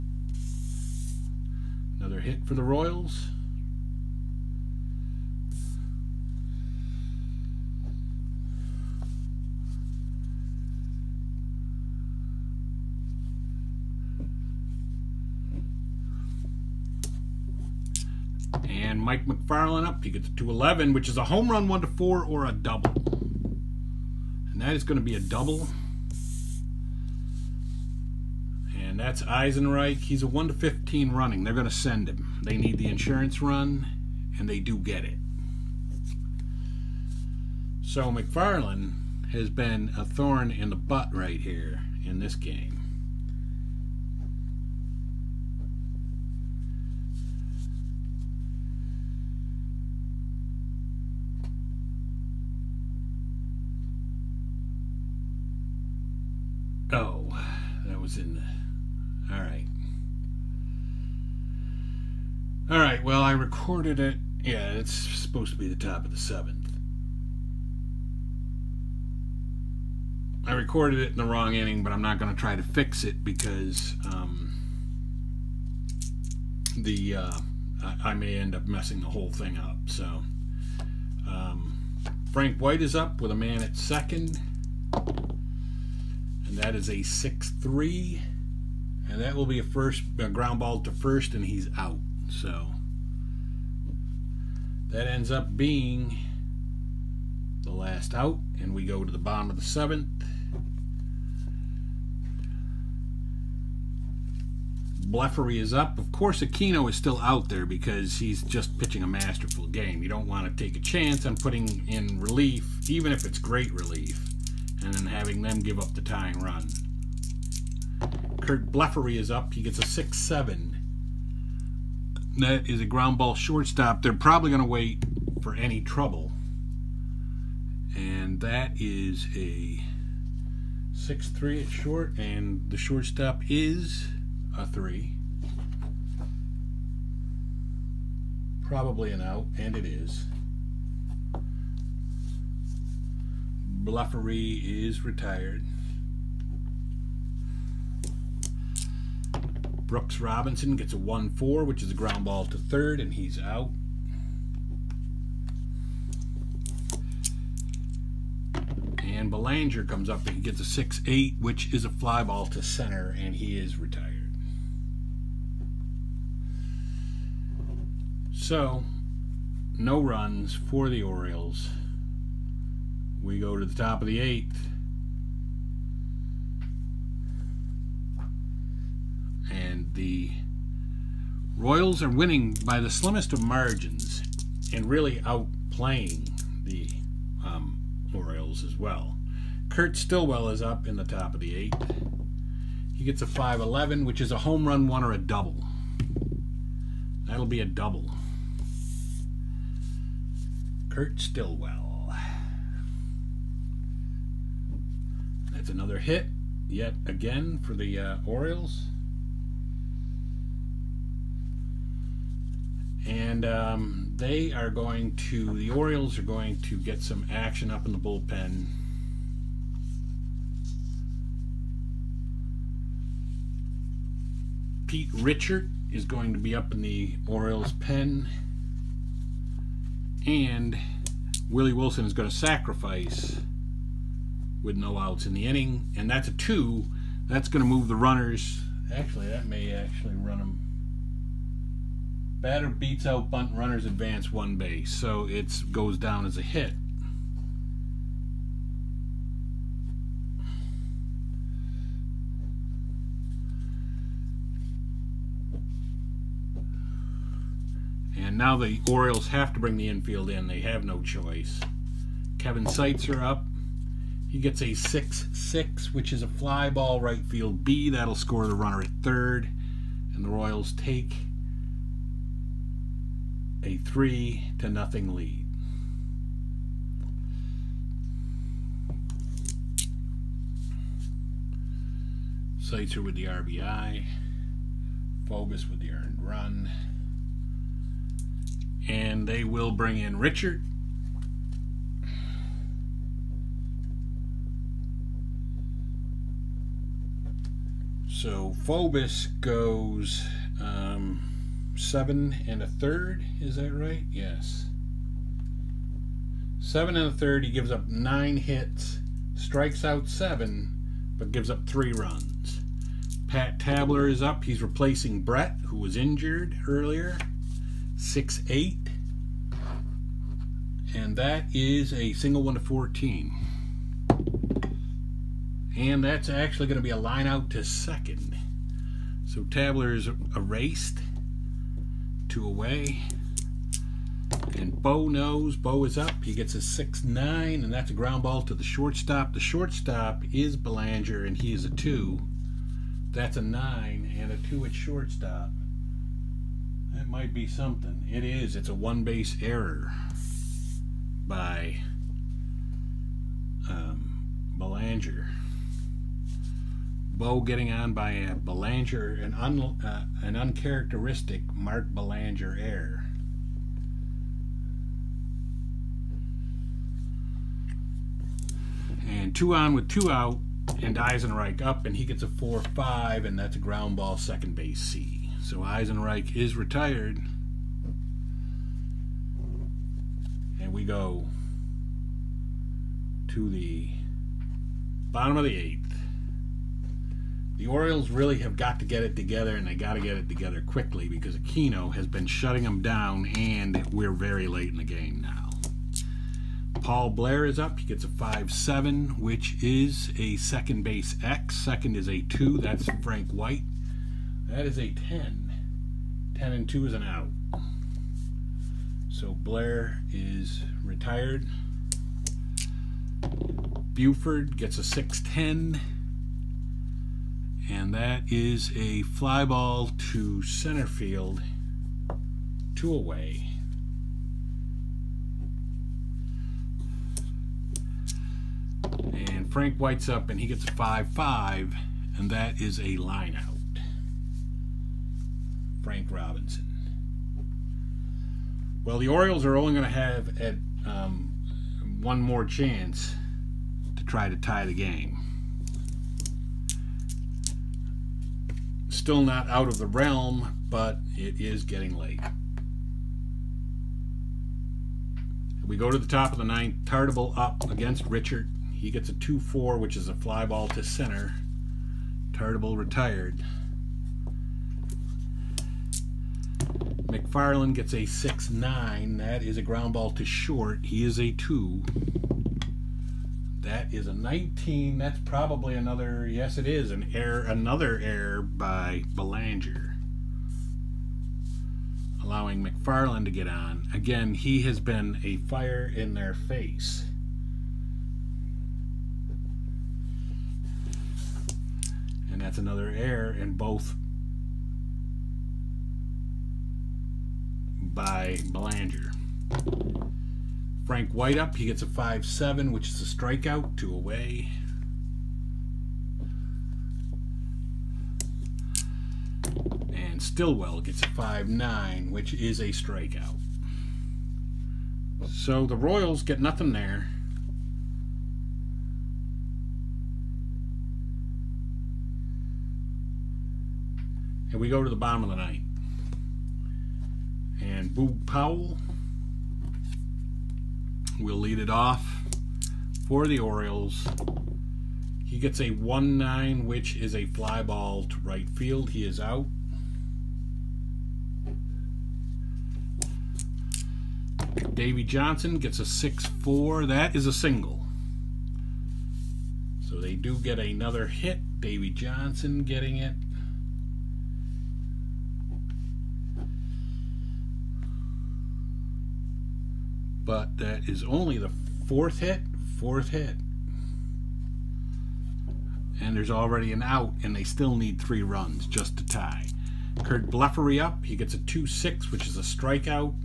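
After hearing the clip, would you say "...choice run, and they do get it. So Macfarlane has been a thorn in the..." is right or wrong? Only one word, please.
wrong.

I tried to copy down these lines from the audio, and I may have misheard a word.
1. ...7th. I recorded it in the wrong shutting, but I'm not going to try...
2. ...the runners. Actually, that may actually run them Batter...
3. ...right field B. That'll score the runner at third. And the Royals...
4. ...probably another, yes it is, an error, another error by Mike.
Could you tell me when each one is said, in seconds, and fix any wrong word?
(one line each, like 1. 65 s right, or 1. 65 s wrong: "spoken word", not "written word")
1. 66 s wrong: "inning", not "shutting"
2. 237 s right
3. 267 s right
4. 475 s wrong: "Belanger", not "Mike".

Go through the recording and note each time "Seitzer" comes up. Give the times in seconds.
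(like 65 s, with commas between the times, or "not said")
262 s, 282 s.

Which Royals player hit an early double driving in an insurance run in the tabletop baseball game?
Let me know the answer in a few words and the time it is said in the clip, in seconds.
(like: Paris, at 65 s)
Mike Macfarlane, at 19 s.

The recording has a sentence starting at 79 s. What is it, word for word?
So um, Frank White is up with a man at second, and that is a 6-3.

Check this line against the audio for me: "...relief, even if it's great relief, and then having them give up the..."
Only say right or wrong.
right.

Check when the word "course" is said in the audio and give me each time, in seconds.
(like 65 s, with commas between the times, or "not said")
106 s.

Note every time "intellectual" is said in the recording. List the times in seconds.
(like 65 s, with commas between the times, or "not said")
not said.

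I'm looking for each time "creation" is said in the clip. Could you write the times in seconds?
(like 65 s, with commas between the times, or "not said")
not said.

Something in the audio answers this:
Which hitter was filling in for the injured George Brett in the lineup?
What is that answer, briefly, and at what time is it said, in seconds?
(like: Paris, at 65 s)
Pat Tabler, at 313 s.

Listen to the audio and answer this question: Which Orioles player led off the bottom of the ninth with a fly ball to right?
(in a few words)
Boog Powell.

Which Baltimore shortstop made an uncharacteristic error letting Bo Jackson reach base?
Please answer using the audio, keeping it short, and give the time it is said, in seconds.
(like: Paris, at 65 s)
Mark Belanger, at 361 s.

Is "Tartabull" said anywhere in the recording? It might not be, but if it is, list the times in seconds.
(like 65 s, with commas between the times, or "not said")
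456 s, 462 s.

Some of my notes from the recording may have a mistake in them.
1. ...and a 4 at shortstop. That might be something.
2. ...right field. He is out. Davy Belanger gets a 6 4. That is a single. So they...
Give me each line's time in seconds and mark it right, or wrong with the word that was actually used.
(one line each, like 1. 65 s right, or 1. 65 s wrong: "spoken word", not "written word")
1. 344 s wrong: "2", not "4"
2. 538 s wrong: "Johnson", not "Belanger".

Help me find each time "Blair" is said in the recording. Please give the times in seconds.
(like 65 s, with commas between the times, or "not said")
397 s, 409 s.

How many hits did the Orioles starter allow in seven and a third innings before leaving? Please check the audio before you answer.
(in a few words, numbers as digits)
9.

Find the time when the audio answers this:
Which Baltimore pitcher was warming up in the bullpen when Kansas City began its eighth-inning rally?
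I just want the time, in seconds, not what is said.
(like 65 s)
224 s.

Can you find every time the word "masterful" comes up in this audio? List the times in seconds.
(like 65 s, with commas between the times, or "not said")
109 s.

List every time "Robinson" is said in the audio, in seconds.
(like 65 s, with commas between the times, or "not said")
150 s, 436 s.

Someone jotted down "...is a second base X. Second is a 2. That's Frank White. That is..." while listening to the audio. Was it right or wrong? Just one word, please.
right.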